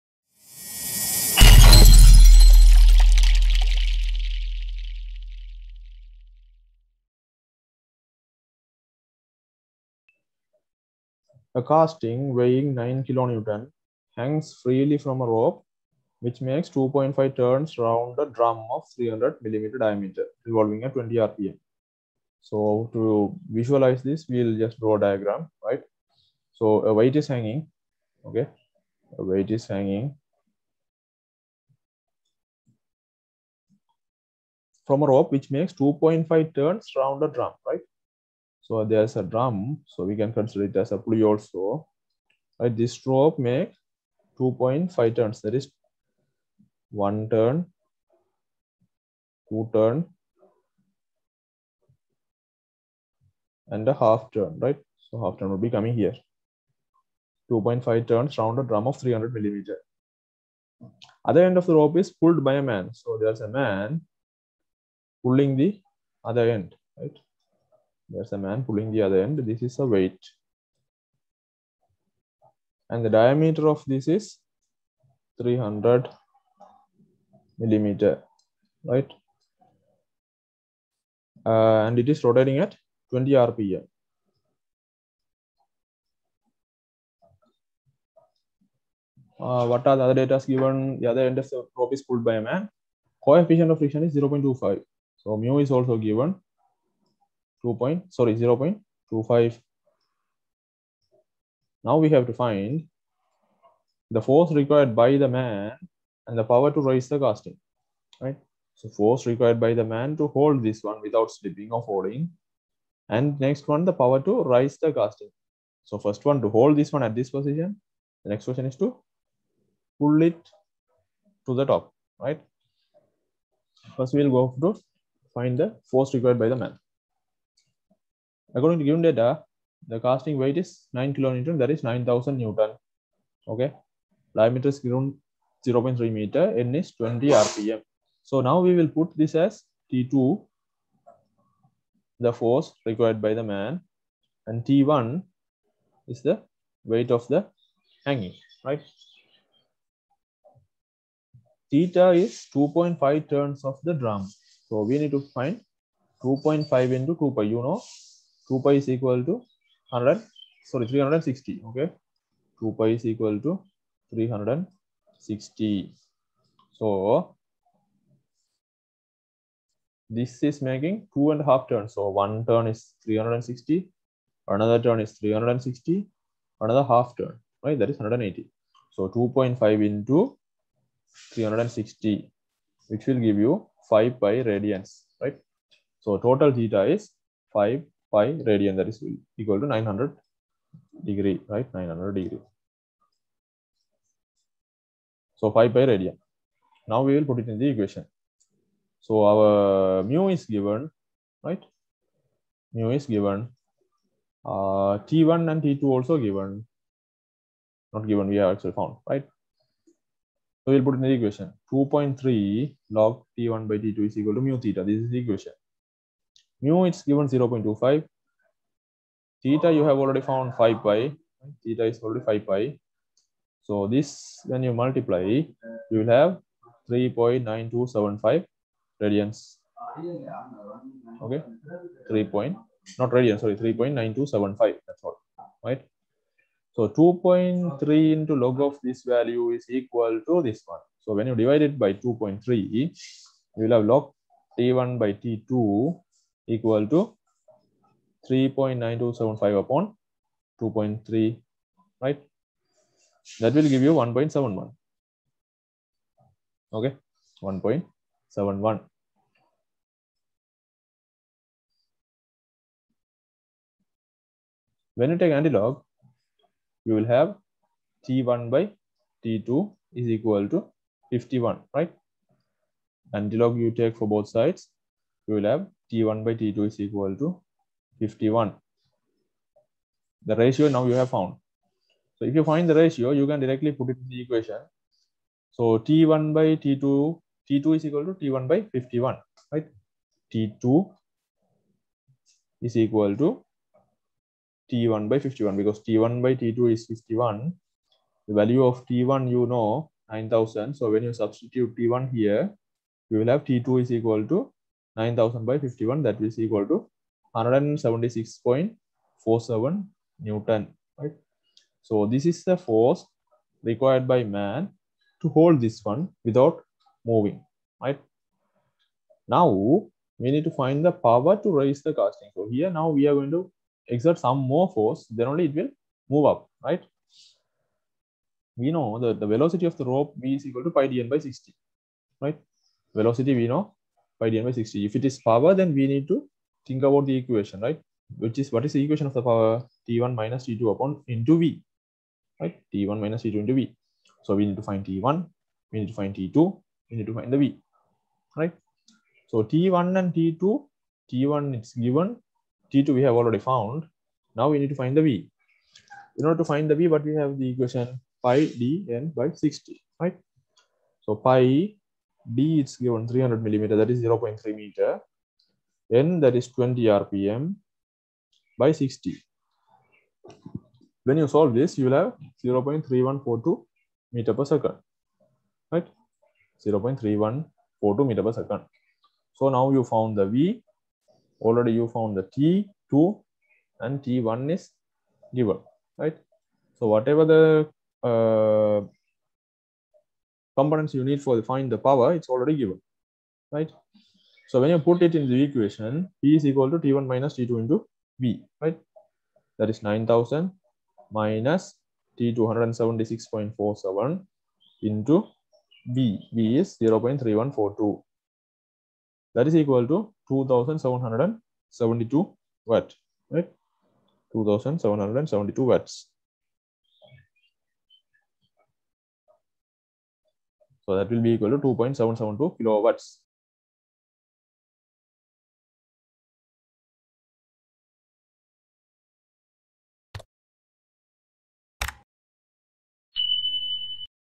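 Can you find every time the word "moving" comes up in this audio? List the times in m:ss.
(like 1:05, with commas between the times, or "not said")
5:17.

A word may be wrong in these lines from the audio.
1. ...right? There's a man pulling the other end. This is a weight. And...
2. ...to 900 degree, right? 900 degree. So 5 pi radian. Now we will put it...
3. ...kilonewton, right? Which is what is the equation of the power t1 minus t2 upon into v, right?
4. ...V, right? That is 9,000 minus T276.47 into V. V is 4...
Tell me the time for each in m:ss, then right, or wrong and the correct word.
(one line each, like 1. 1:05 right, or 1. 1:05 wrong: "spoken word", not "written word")
1. 1:06 right
2. 3:09 right
3. 5:37 wrong: "equation", not "kilonewton"
4. 6:38 wrong: "0", not "4".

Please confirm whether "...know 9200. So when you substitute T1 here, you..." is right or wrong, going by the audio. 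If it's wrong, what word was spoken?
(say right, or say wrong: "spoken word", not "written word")
wrong: "9000", not "9200".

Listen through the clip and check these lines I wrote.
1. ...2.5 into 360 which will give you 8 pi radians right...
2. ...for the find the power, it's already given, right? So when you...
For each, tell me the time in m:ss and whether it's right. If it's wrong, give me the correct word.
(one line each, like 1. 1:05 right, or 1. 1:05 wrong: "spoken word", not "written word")
1. 2:59 wrong: "5", not "8"
2. 6:31 right.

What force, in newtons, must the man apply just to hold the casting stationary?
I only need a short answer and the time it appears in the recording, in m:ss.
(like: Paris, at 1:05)
176.47 newtons, at 5:07.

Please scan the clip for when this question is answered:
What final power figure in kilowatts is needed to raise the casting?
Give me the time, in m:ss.
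7:01.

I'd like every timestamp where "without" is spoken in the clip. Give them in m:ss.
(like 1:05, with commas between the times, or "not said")
1:51, 5:16.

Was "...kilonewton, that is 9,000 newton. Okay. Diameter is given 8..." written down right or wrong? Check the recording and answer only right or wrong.
wrong.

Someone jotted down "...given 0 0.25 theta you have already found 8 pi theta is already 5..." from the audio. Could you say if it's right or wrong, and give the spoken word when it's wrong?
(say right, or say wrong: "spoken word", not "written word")
wrong: "5", not "8".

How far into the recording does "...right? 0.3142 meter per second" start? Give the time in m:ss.
6:15.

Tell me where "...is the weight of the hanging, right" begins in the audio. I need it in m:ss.
2:26.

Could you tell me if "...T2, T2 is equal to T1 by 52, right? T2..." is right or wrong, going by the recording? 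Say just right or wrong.
wrong.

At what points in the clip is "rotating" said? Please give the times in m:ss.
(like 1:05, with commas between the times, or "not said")
1:22.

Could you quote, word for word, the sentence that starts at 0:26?
So a weight is hanging, okay?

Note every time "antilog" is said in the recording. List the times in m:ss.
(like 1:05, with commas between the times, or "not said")
4:25, 4:33.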